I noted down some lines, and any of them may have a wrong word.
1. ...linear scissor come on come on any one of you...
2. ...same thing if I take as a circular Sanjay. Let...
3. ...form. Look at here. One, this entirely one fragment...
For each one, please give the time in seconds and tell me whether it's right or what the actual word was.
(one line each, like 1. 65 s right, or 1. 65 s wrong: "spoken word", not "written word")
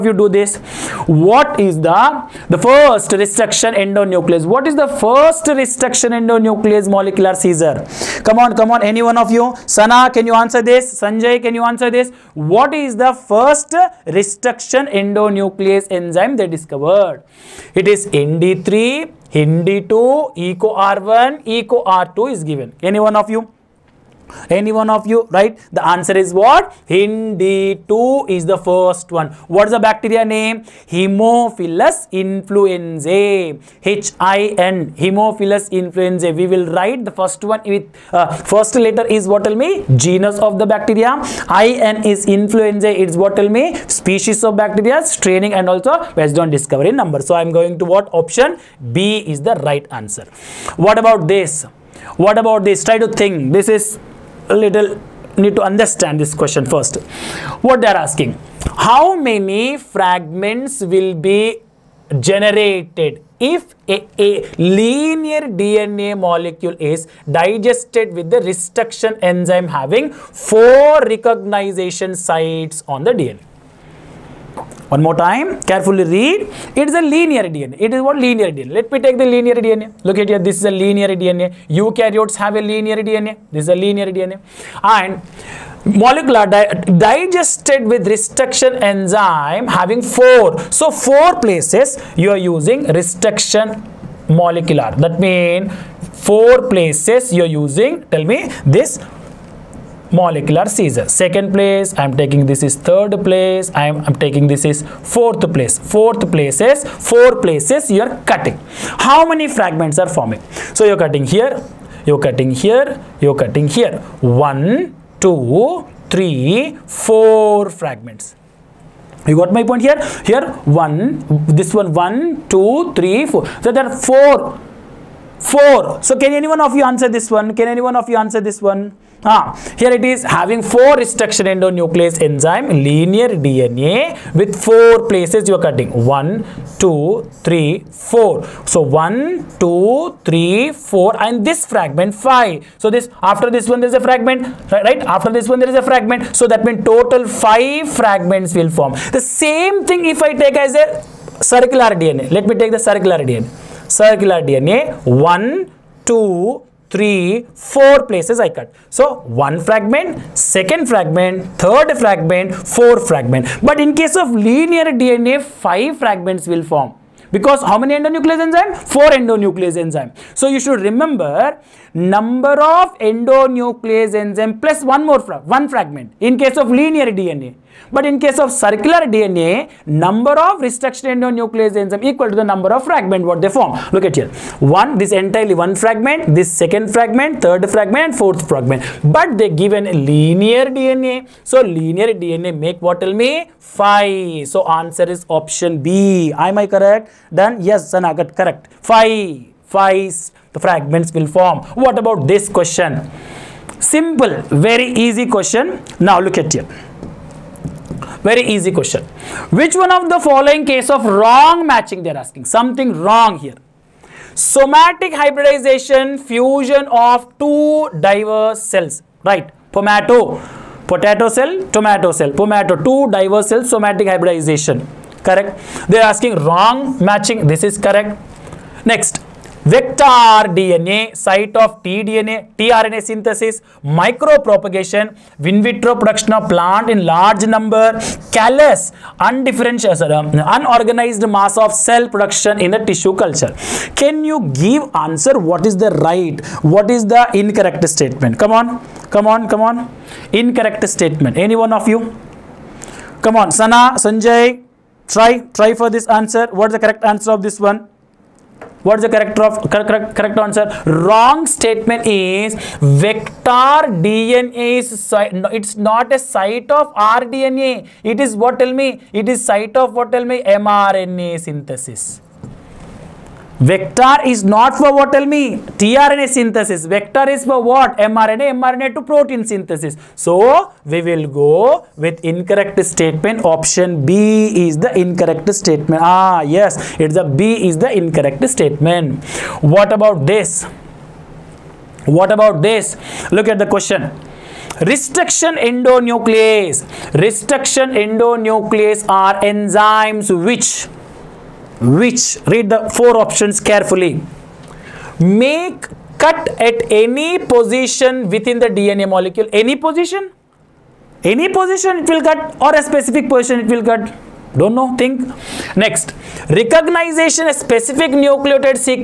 1. 6 s wrong: "molecular", not "linear"
2. 149 s wrong: "DNA", not "Sanjay"
3. 183 s right.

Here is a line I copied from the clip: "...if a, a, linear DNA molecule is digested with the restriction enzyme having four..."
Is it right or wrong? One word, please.
right.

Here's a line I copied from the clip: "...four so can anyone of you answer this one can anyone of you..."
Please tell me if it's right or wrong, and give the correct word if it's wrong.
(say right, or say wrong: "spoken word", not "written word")
right.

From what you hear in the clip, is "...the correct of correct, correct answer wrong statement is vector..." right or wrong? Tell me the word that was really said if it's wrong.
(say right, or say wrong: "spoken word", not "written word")
right.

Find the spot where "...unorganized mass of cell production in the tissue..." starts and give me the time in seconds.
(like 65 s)
240 s.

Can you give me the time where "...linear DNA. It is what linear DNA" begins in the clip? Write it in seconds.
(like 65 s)
77 s.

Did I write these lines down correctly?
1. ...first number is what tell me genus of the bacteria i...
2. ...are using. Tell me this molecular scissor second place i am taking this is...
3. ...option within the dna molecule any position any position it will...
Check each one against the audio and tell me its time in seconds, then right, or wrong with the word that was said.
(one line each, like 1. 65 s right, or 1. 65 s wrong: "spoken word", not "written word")
1. 38 s wrong: "letter", not "number"
2. 97 s right
3. 307 s wrong: "position", not "option".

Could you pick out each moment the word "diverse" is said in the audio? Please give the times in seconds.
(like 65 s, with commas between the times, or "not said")
218 s, 223 s.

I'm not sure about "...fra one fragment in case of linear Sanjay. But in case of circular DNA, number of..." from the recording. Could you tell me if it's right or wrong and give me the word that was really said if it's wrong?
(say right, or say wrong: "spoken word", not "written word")
wrong: "DNA", not "Sanjay".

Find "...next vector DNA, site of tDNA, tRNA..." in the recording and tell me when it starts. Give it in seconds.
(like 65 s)
228 s.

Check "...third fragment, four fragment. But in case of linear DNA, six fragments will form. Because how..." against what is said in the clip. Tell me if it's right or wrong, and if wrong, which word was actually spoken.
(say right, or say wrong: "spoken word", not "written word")
wrong: "five", not "six".